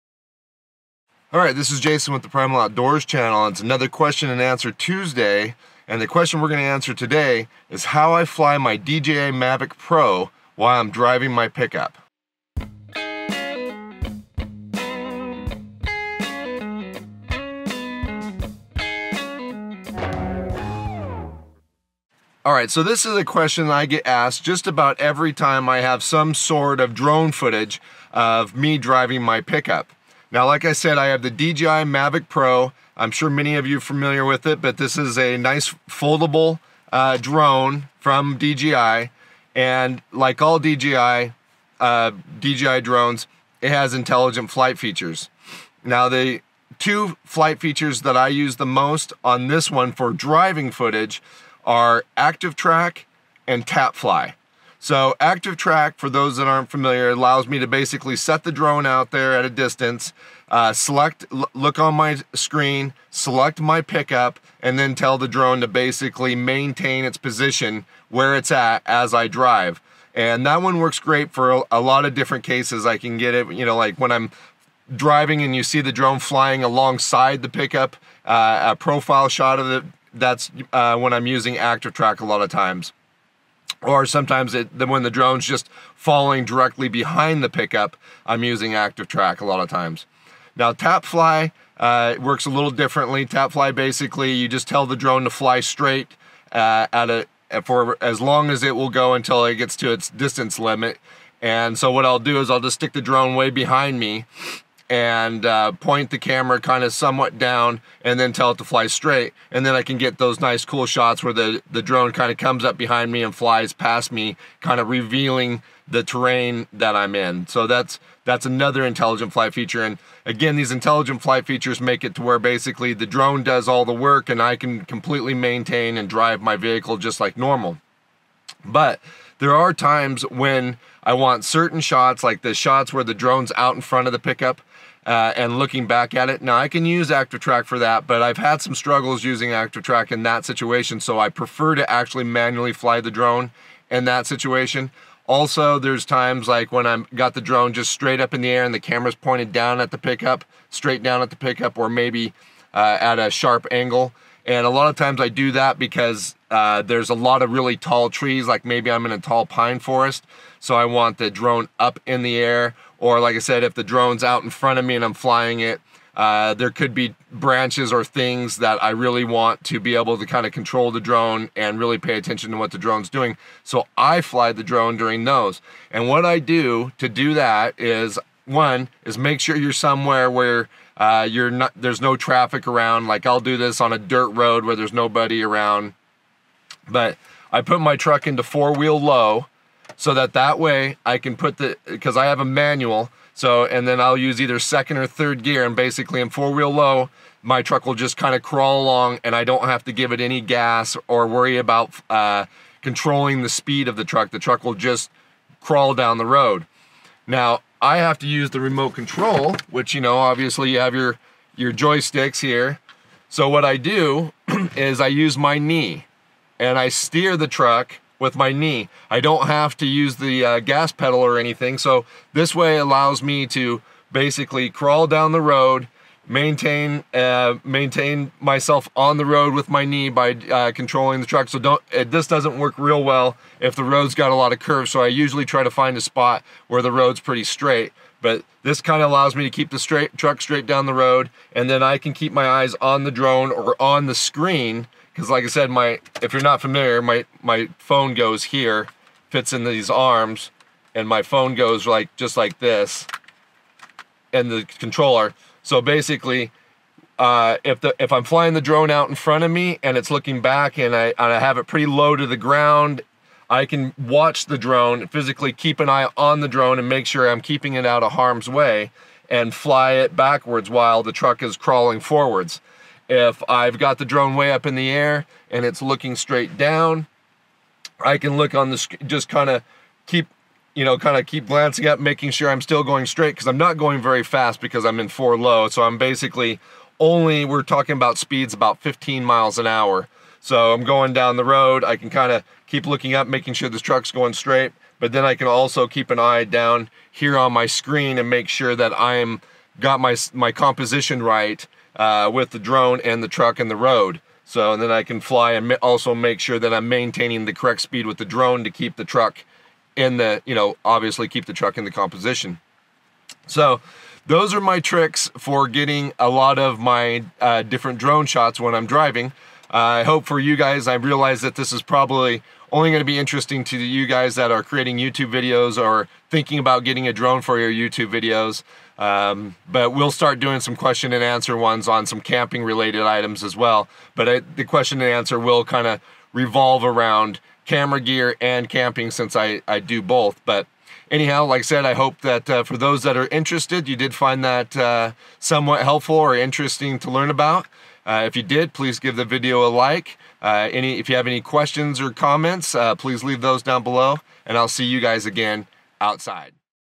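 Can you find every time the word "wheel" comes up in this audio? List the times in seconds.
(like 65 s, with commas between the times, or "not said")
188 s, 196 s.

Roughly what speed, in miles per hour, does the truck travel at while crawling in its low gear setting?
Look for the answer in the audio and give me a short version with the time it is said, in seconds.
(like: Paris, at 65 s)
15 miles an hour, at 288 s.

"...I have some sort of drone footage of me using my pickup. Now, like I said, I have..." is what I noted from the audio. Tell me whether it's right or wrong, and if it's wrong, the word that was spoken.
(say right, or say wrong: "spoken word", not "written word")
wrong: "driving", not "using".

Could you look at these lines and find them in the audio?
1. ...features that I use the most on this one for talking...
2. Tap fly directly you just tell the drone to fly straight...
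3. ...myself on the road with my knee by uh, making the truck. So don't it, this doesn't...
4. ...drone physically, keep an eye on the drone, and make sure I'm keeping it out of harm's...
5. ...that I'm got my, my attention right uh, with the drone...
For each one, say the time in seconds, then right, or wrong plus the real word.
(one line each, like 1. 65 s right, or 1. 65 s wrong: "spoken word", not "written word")
1. 47 s wrong: "driving", not "talking"
2. 93 s wrong: "basically", not "directly"
3. 228 s wrong: "controlling", not "making"
4. 264 s right
5. 298 s wrong: "composition", not "attention".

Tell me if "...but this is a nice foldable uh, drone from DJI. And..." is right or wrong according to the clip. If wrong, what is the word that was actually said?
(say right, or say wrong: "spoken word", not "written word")
right.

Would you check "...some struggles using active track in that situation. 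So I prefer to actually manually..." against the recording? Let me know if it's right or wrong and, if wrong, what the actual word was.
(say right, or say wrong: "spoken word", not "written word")
right.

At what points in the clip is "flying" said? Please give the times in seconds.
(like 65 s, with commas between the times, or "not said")
76 s, 165 s, 258 s.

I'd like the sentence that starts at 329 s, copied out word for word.
Um, but we'll start doing some question and answer ones on some camping related items as well.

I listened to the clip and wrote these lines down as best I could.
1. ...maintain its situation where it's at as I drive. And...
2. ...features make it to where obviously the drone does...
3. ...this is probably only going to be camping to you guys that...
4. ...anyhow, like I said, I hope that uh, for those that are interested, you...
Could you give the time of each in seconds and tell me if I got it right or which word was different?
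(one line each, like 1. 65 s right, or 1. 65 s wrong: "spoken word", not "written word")
1. 66 s wrong: "position", not "situation"
2. 121 s wrong: "basically", not "obviously"
3. 321 s wrong: "interesting", not "camping"
4. 341 s right.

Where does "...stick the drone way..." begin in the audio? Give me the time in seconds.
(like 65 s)
102 s.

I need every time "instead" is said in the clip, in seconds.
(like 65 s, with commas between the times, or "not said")
not said.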